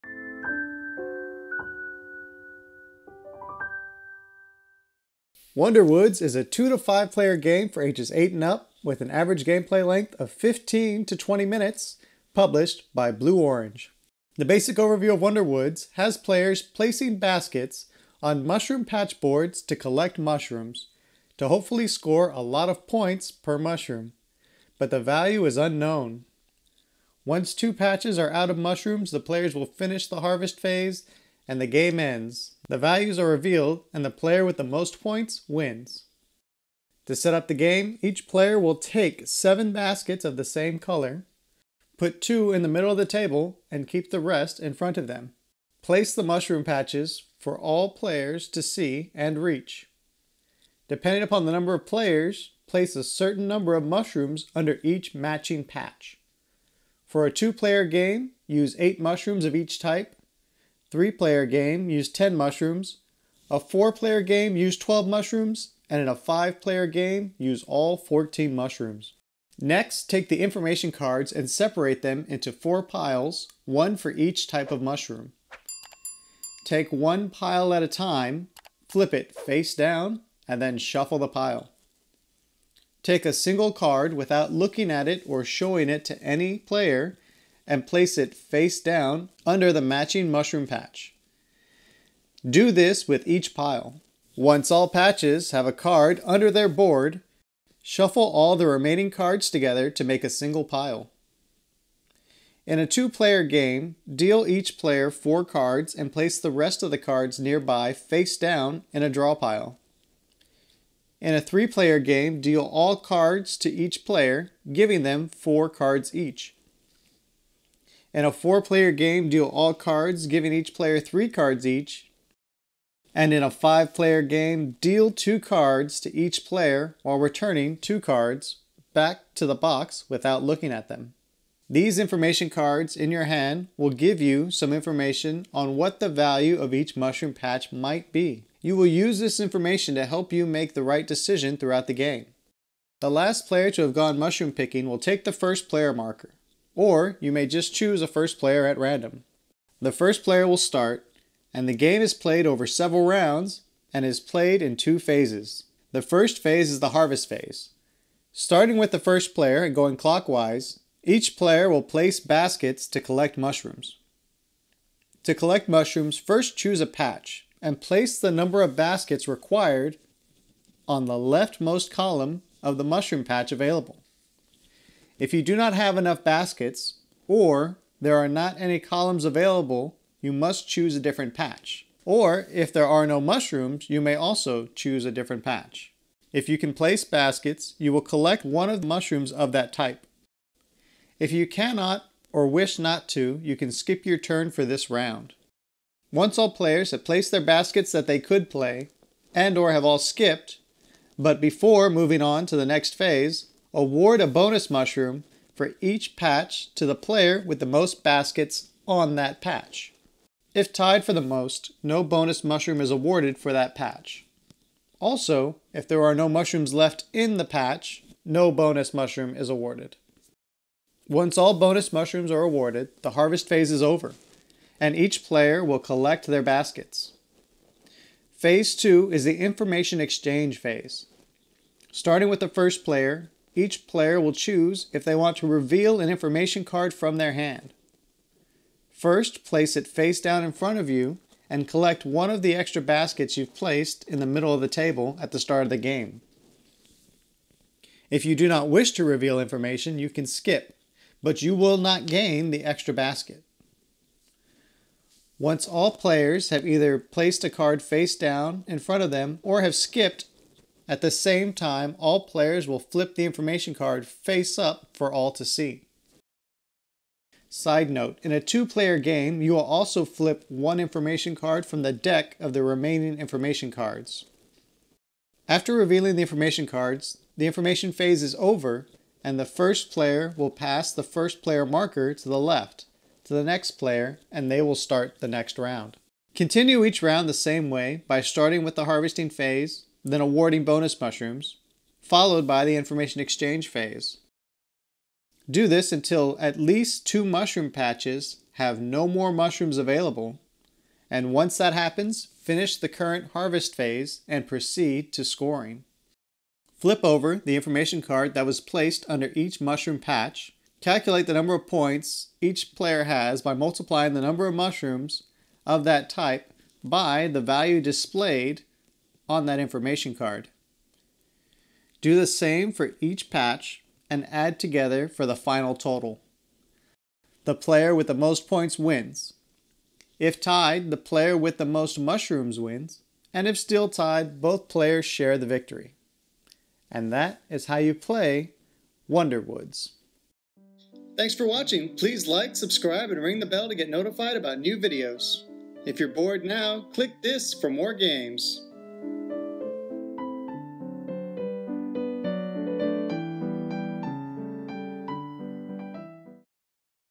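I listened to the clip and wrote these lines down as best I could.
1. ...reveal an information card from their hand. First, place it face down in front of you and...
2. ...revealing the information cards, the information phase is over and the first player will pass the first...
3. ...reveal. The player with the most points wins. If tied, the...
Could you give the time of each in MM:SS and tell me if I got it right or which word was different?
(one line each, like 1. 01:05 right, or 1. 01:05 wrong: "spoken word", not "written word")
1. 03:55 right
2. 04:35 right
3. 05:25 wrong: "total", not "reveal".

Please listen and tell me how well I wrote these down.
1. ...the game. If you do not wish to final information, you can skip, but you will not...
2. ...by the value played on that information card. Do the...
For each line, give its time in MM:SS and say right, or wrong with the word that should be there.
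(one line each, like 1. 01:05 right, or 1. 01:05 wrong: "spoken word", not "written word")
1. 04:05 wrong: "reveal", not "final"
2. 05:16 wrong: "displayed", not "played".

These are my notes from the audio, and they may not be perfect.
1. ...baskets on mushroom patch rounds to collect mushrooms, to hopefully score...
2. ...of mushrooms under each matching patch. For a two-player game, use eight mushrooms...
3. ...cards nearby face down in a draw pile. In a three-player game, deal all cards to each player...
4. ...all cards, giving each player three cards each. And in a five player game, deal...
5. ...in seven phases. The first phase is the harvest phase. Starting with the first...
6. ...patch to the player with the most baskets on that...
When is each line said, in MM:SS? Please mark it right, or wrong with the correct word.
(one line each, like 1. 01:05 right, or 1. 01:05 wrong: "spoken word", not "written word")
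1. 00:17 wrong: "boards", not "rounds"
2. 00:53 right
3. 01:46 right
4. 01:59 right
5. 02:34 wrong: "two", not "seven"
6. 03:26 right.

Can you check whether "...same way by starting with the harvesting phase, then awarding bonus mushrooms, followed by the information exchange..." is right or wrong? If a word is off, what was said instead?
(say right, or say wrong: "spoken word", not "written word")
right.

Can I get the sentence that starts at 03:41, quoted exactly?
Once all bonus mushrooms are awarded, the harvest phase is over, and each player will collect their baskets.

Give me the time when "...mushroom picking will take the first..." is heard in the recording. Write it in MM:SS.
02:24.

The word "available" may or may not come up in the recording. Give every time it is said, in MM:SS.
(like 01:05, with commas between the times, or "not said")
02:53, 02:59, 04:59.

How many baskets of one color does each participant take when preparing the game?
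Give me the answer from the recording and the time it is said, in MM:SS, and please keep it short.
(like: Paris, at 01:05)
7, at 00:39.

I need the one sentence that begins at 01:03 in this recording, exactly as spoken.
A four-player game, use 12 mushrooms.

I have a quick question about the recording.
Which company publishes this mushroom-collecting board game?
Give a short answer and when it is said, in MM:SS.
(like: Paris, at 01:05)
Blue Orange, at 00:13.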